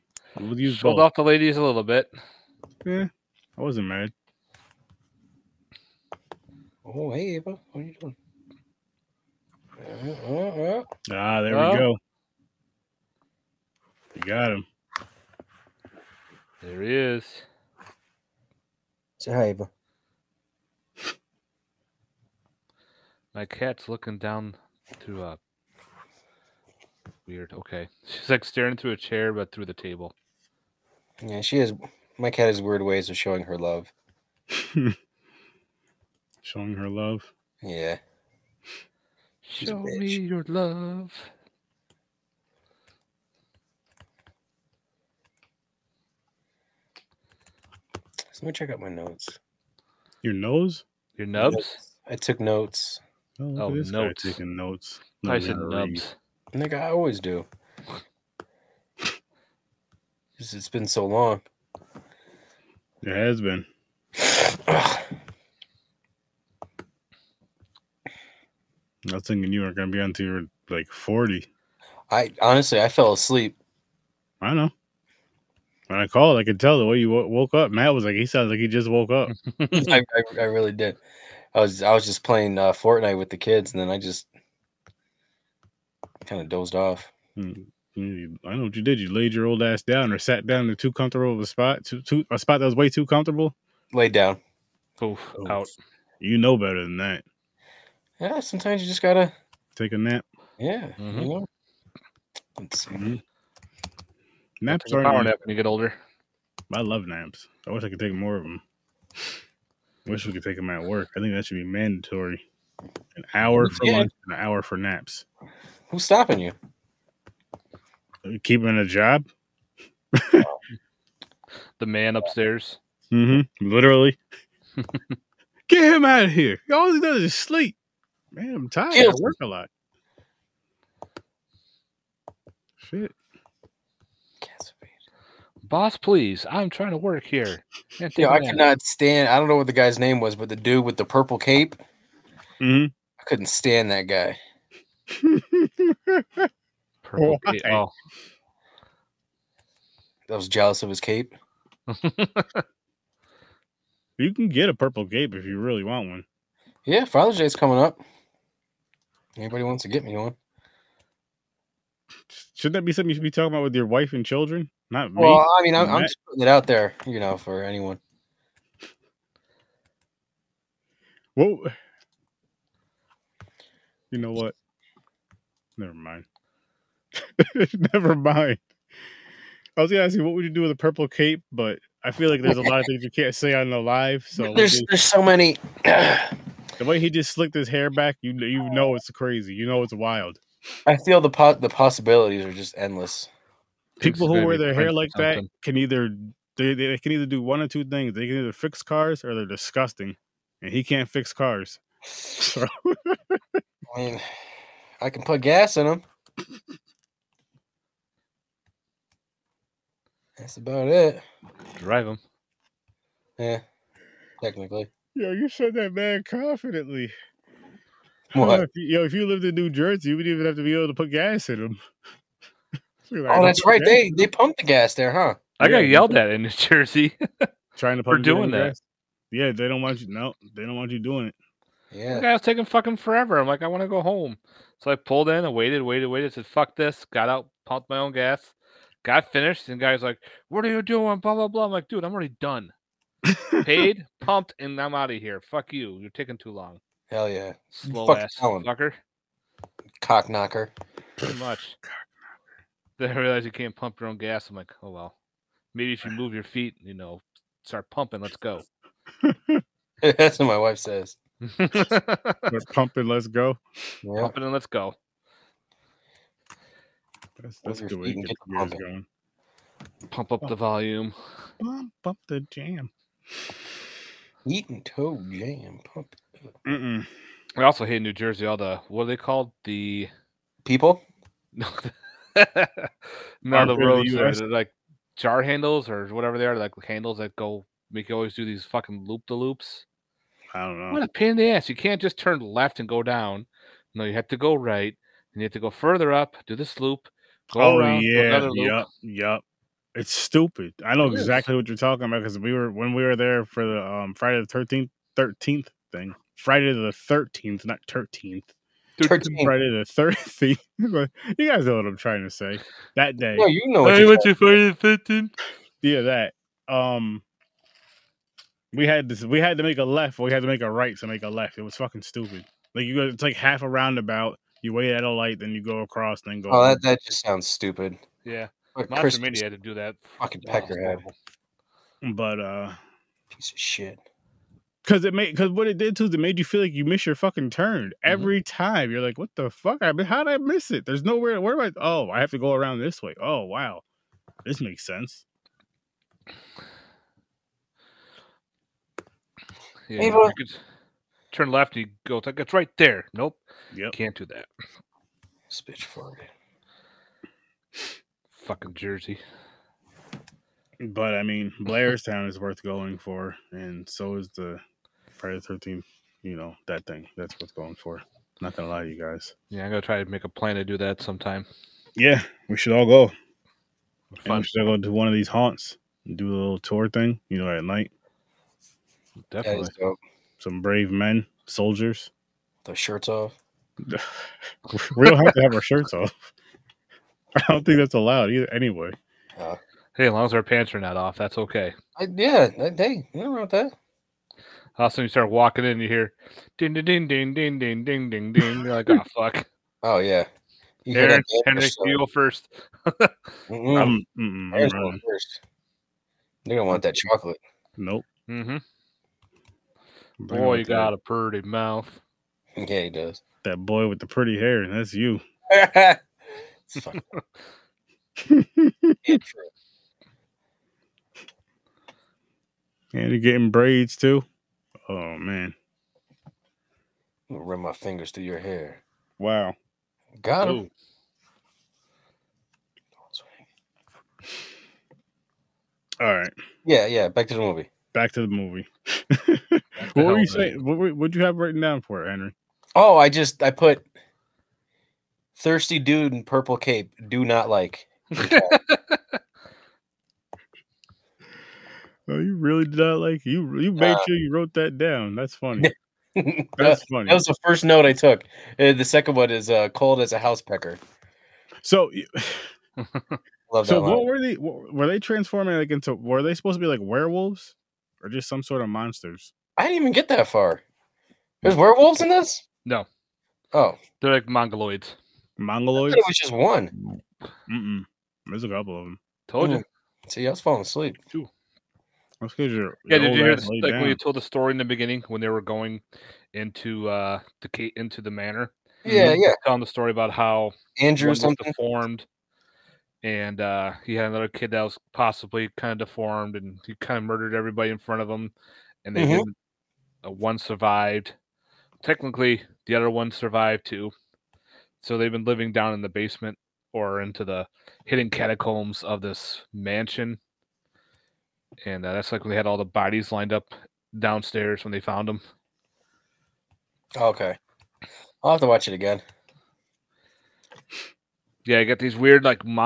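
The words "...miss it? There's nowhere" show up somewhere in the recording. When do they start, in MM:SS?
05:40.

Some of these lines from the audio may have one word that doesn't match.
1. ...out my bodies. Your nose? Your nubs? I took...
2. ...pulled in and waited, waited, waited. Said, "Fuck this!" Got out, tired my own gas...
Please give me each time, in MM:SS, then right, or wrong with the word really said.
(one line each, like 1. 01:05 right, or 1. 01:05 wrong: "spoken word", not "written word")
1. 00:48 wrong: "notes", not "bodies"
2. 03:54 wrong: "pumped", not "tired".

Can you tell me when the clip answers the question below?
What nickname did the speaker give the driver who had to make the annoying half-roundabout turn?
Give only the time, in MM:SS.
05:28.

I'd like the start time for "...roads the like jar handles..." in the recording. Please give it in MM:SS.
04:43.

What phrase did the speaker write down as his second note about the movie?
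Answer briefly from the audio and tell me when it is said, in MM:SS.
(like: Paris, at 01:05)
Cold as a house pecker, at 07:39.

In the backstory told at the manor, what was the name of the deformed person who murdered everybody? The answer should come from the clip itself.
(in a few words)
Andrew.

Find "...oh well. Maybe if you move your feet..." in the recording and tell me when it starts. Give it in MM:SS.
04:14.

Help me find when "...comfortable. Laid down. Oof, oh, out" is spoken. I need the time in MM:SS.
01:33.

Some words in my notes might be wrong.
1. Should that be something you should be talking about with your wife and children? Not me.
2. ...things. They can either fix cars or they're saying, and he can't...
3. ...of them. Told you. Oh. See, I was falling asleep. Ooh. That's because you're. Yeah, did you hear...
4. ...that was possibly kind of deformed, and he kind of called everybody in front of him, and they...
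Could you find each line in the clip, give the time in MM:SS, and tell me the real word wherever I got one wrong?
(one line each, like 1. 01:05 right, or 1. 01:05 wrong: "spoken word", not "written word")
1. 02:42 right
2. 03:17 wrong: "disgusting", not "saying"
3. 07:58 right
4. 08:14 wrong: "murdered", not "called".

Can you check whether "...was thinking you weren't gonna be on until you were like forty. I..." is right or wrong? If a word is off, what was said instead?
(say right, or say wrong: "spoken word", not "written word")
right.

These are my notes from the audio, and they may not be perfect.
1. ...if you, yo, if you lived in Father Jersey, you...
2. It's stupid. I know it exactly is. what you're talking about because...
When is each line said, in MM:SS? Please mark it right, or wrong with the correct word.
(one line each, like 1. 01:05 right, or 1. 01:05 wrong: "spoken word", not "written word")
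1. 03:38 wrong: "New", not "Father"
2. 04:59 right.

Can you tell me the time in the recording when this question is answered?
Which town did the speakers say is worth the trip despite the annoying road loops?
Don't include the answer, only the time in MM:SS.
06:01.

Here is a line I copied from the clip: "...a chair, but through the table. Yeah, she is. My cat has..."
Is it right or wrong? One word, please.
right.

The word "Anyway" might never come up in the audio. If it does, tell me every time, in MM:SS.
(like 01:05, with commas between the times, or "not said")
06:28.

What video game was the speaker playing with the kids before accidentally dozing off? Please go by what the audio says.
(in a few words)
Fortnite.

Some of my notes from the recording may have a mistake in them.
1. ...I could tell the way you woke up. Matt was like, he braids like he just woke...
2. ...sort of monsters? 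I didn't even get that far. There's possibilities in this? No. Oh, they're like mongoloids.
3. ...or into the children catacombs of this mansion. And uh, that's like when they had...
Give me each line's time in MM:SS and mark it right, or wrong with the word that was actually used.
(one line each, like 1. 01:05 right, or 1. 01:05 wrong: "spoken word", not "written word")
1. 01:16 wrong: "sounds", not "braids"
2. 07:48 wrong: "werewolves", not "possibilities"
3. 08:26 wrong: "hidden", not "children".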